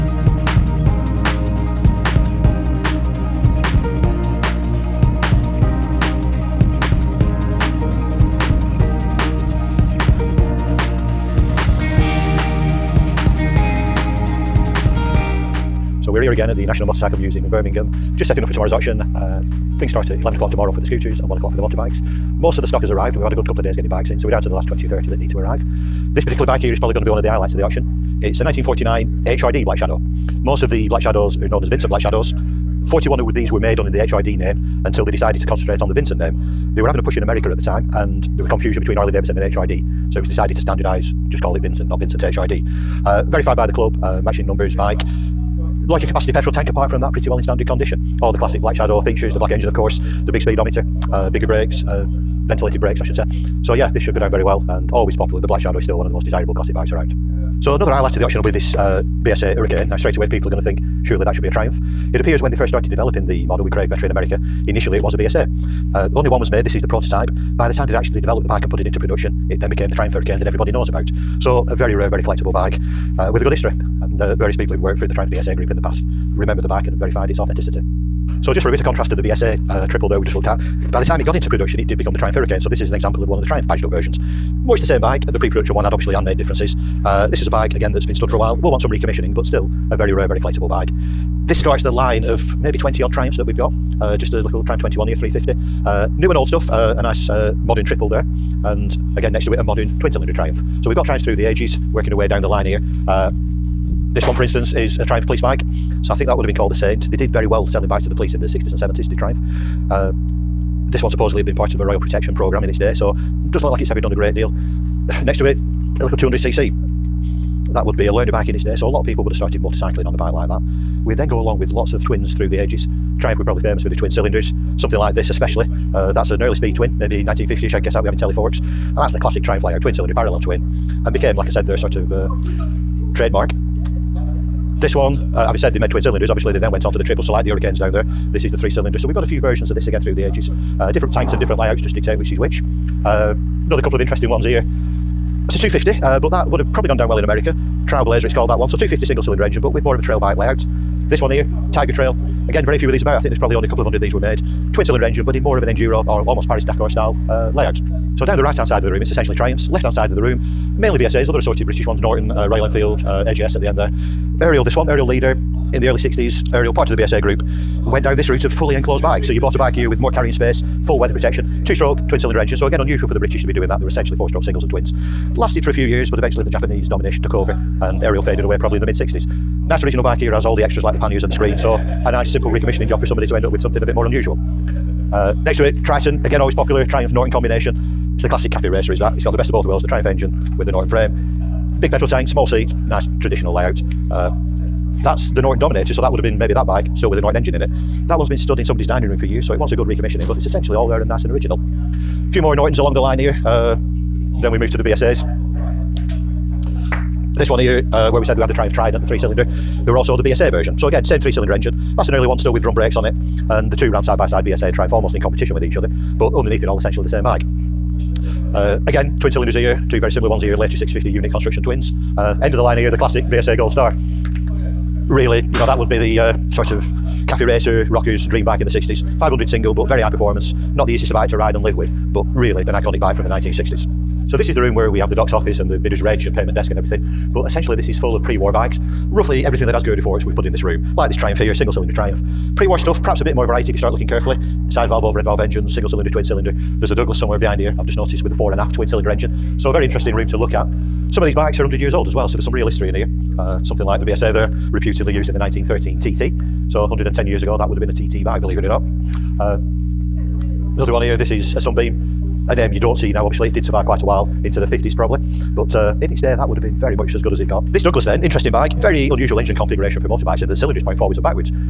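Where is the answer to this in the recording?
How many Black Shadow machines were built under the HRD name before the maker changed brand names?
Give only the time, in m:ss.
0:32.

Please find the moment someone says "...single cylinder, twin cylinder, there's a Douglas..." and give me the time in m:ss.
4:05.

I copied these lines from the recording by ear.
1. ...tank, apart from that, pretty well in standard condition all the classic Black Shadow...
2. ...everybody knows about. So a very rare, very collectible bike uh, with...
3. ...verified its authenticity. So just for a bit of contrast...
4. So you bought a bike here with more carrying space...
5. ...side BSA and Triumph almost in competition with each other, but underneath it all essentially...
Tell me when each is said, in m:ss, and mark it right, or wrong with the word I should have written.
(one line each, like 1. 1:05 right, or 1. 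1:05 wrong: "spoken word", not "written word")
1. 0:46 right
2. 1:10 right
3. 1:16 right
4. 2:49 right
5. 3:34 right.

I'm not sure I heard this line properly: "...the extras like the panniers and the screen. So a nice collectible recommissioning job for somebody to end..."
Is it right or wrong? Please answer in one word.
wrong.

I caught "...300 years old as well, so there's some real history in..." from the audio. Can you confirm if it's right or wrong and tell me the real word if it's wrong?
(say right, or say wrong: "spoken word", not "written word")
wrong: "100", not "300".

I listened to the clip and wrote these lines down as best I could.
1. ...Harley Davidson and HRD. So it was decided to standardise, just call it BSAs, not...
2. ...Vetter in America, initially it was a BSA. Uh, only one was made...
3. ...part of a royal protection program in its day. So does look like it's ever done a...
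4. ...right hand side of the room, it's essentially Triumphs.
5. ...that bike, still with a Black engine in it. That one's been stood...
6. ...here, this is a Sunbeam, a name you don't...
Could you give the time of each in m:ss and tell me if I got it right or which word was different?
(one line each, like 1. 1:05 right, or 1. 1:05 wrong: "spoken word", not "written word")
1. 0:38 wrong: "Vincent", not "BSAs"
2. 1:03 right
3. 1:51 right
4. 2:38 right
5. 3:16 wrong: "Norton", not "Black"
6. 4:20 right.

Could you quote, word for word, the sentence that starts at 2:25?
It's a 250, uh, but that would have probably gone down well in America.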